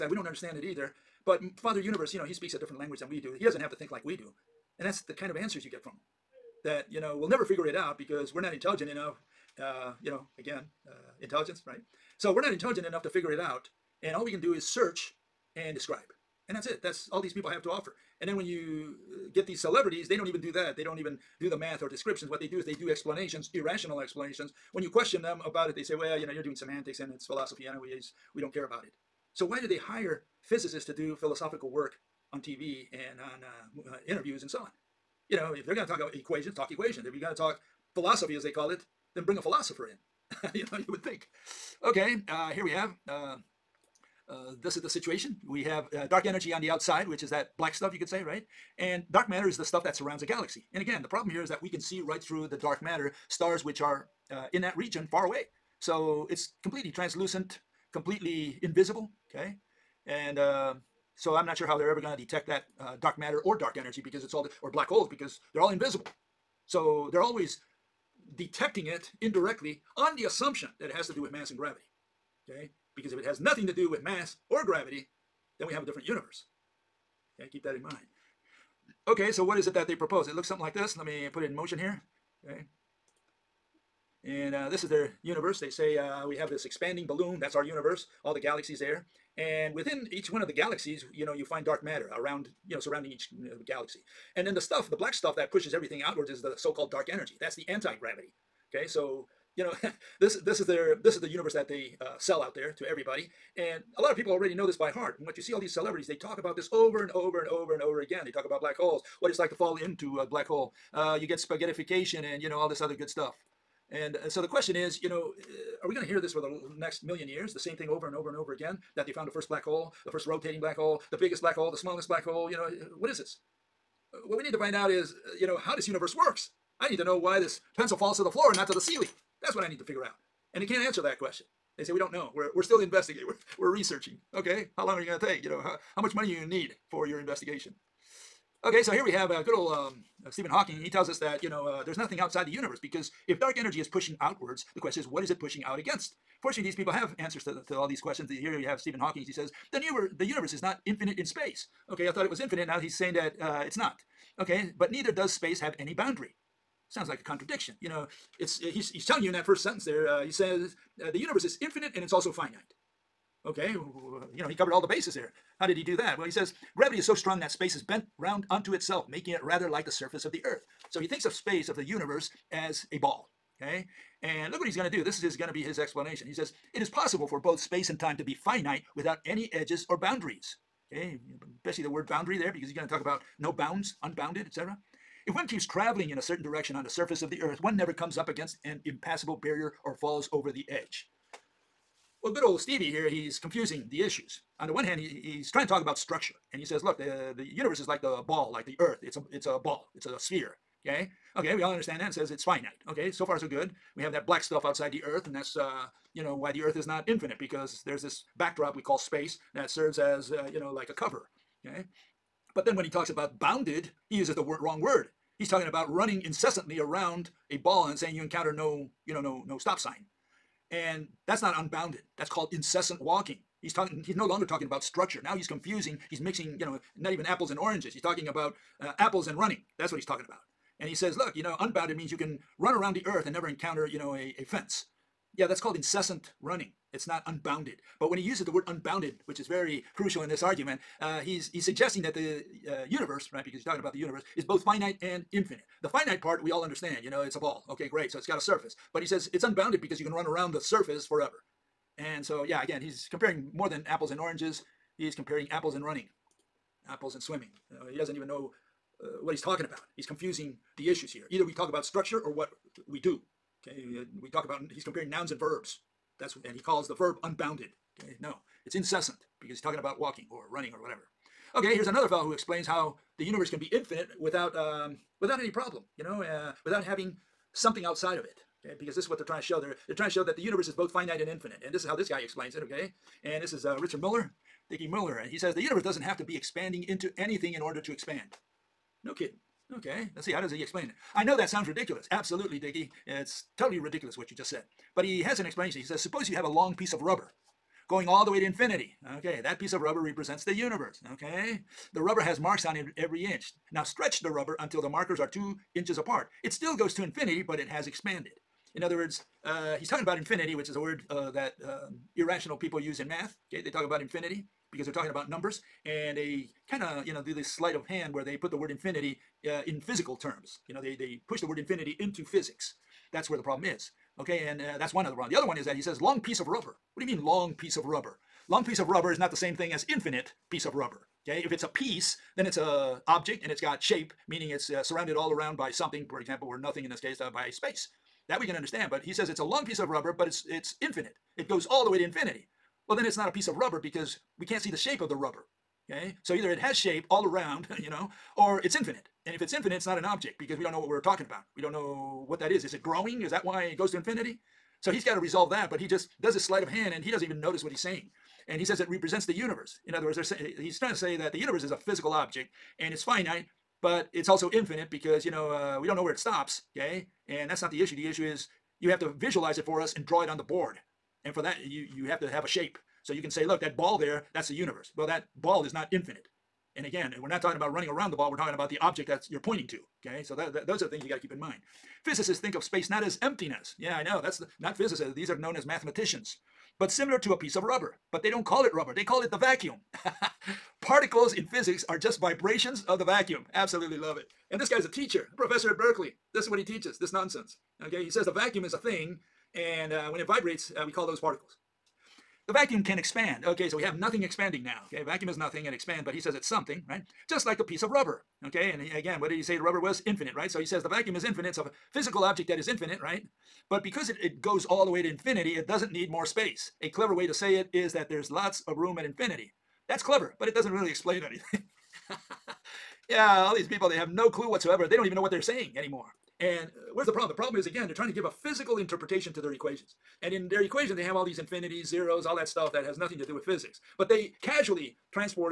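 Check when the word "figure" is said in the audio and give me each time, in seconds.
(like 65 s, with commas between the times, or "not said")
7 s, 13 s, 129 s.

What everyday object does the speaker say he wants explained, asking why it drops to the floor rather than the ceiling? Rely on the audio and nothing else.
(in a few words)
Pencil.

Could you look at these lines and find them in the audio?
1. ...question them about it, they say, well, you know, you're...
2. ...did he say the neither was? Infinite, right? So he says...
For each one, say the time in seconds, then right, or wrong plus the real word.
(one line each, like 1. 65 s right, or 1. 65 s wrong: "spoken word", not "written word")
1. 24 s right
2. 409 s wrong: "rubber", not "neither".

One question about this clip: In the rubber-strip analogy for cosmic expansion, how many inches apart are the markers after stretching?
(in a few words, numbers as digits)
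2 inches.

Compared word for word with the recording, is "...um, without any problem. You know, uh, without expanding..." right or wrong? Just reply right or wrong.
wrong.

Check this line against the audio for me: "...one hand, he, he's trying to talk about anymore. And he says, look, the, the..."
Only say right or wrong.
wrong.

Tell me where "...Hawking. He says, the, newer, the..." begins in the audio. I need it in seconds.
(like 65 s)
148 s.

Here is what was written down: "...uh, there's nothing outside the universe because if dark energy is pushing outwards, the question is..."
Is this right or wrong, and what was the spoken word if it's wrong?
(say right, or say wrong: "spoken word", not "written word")
right.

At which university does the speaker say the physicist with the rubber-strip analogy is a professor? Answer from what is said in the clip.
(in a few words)
Berkeley.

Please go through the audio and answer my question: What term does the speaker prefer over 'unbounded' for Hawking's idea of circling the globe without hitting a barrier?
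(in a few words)
Incessant walking.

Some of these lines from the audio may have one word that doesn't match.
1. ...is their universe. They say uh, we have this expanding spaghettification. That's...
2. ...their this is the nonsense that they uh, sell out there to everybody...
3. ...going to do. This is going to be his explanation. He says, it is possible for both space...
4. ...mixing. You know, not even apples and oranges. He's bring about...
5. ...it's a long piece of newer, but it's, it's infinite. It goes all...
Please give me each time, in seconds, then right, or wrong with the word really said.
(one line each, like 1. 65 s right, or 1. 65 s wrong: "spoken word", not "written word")
1. 84 s wrong: "balloon", not "spaghettification"
2. 100 s wrong: "universe", not "nonsense"
3. 174 s right
4. 226 s wrong: "talking", not "bring"
5. 339 s wrong: "rubber", not "newer".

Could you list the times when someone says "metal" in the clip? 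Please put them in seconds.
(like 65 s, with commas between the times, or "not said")
not said.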